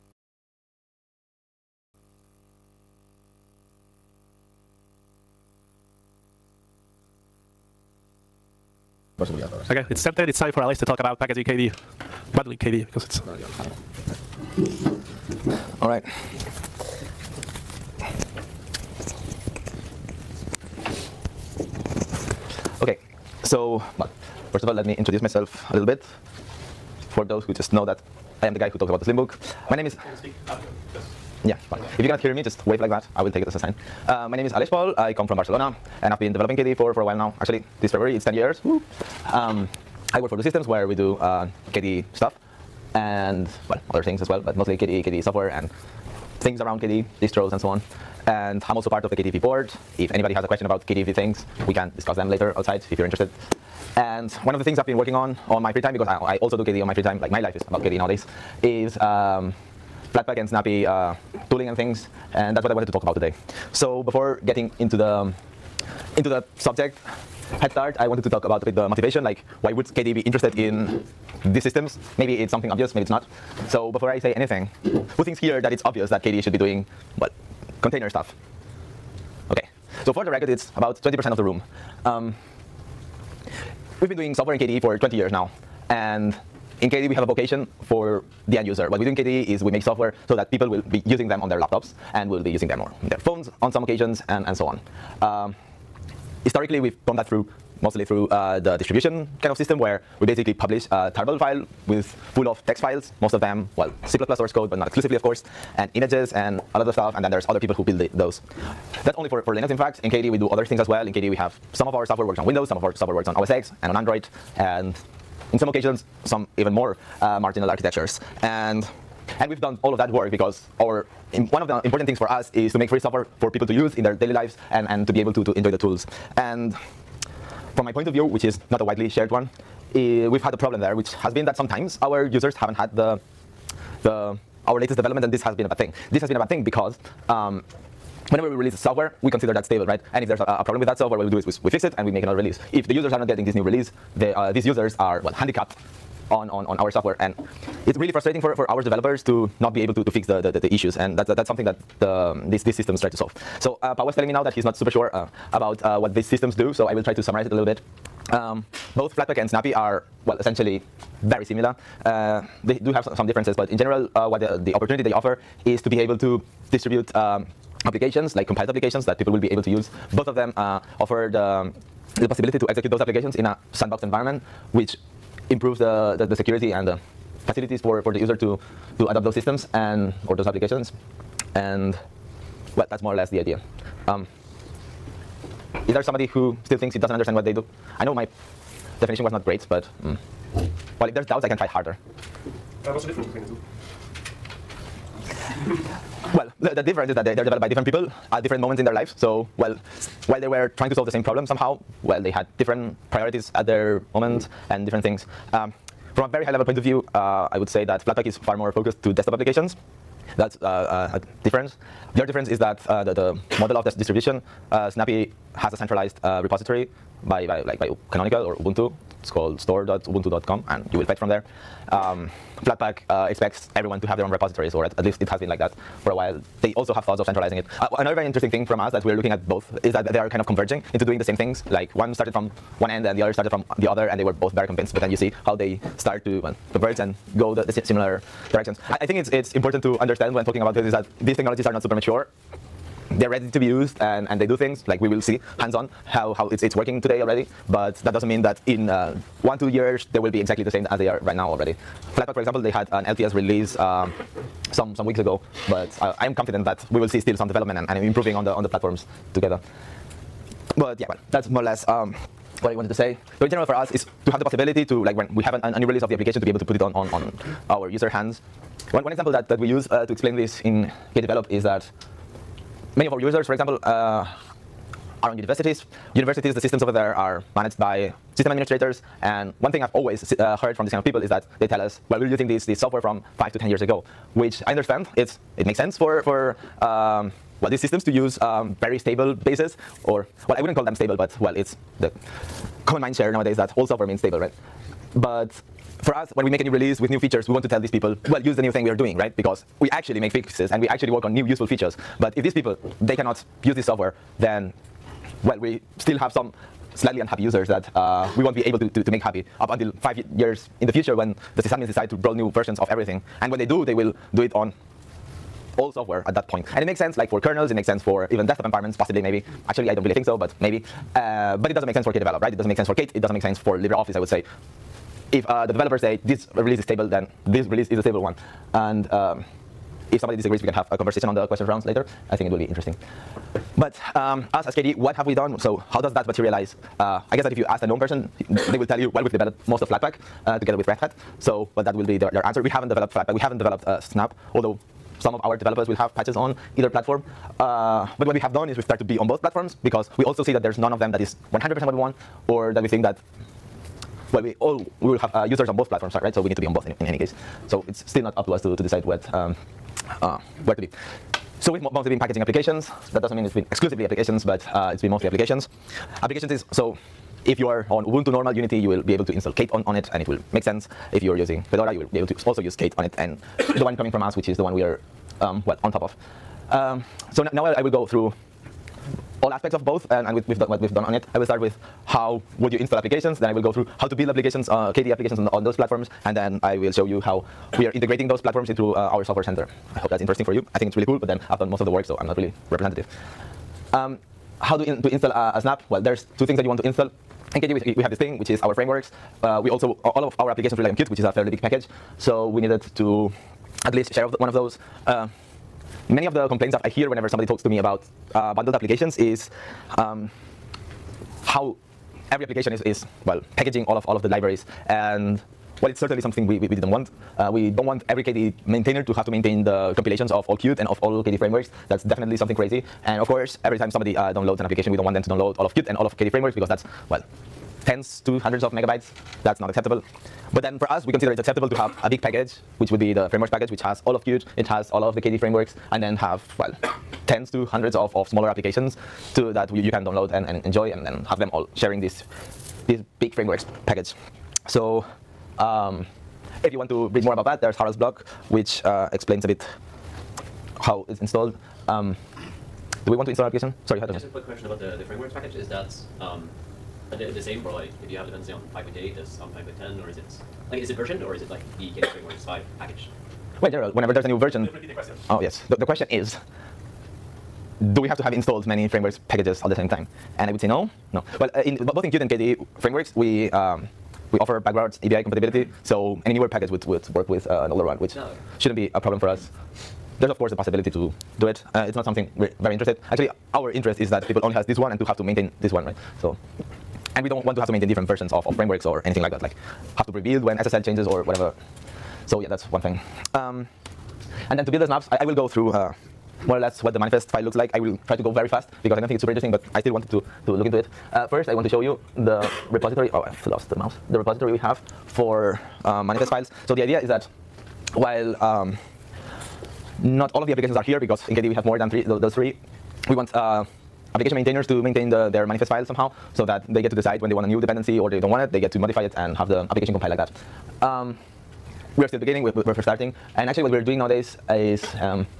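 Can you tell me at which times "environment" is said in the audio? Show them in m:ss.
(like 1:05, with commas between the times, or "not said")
2:54, 5:18.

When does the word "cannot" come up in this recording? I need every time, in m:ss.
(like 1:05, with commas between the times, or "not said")
0:32, 5:03.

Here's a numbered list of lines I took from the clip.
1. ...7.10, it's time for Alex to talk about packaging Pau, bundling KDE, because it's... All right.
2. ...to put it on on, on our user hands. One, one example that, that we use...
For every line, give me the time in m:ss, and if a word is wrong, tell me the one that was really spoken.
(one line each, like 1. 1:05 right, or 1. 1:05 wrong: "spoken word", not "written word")
1. 0:10 wrong: "KDE", not "Pau"
2. 4:26 right.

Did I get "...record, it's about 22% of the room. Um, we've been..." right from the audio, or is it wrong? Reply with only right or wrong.
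wrong.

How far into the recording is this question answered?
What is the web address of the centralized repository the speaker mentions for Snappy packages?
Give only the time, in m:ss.
3:39.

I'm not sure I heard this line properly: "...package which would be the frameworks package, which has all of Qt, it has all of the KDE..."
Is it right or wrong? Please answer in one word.
right.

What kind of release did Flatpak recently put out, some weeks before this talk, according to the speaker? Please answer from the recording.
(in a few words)
LTS release.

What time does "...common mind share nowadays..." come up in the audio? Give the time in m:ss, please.
4:52.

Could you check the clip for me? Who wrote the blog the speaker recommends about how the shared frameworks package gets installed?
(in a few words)
Harald.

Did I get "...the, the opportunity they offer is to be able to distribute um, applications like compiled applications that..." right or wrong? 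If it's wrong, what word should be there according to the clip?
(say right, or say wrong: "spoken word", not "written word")
right.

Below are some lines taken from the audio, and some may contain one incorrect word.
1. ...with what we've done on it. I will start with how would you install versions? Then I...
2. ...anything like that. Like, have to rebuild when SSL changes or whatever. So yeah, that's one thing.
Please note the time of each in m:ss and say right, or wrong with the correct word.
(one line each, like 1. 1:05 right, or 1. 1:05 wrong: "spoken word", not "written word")
1. 6:20 wrong: "applications", not "versions"
2. 8:09 right.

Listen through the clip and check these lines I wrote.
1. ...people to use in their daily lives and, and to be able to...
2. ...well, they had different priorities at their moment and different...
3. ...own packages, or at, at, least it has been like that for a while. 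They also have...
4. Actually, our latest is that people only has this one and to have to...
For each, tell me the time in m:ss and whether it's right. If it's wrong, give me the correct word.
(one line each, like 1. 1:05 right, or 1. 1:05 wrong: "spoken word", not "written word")
1. 2:03 right
2. 3:22 right
3. 3:44 wrong: "repositories", not "packages"
4. 8:03 wrong: "interest", not "latest".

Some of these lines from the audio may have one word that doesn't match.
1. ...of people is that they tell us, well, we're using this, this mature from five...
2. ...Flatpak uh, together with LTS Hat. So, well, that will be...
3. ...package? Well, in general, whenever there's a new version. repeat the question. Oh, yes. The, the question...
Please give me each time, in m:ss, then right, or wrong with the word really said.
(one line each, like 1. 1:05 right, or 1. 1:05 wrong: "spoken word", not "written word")
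1. 4:40 wrong: "software", not "mature"
2. 5:39 wrong: "Red", not "LTS"
3. 7:42 right.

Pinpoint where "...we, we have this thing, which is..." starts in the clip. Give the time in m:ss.
6:37.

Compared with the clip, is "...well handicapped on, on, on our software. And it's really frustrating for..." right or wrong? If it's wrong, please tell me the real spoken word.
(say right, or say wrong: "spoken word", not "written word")
right.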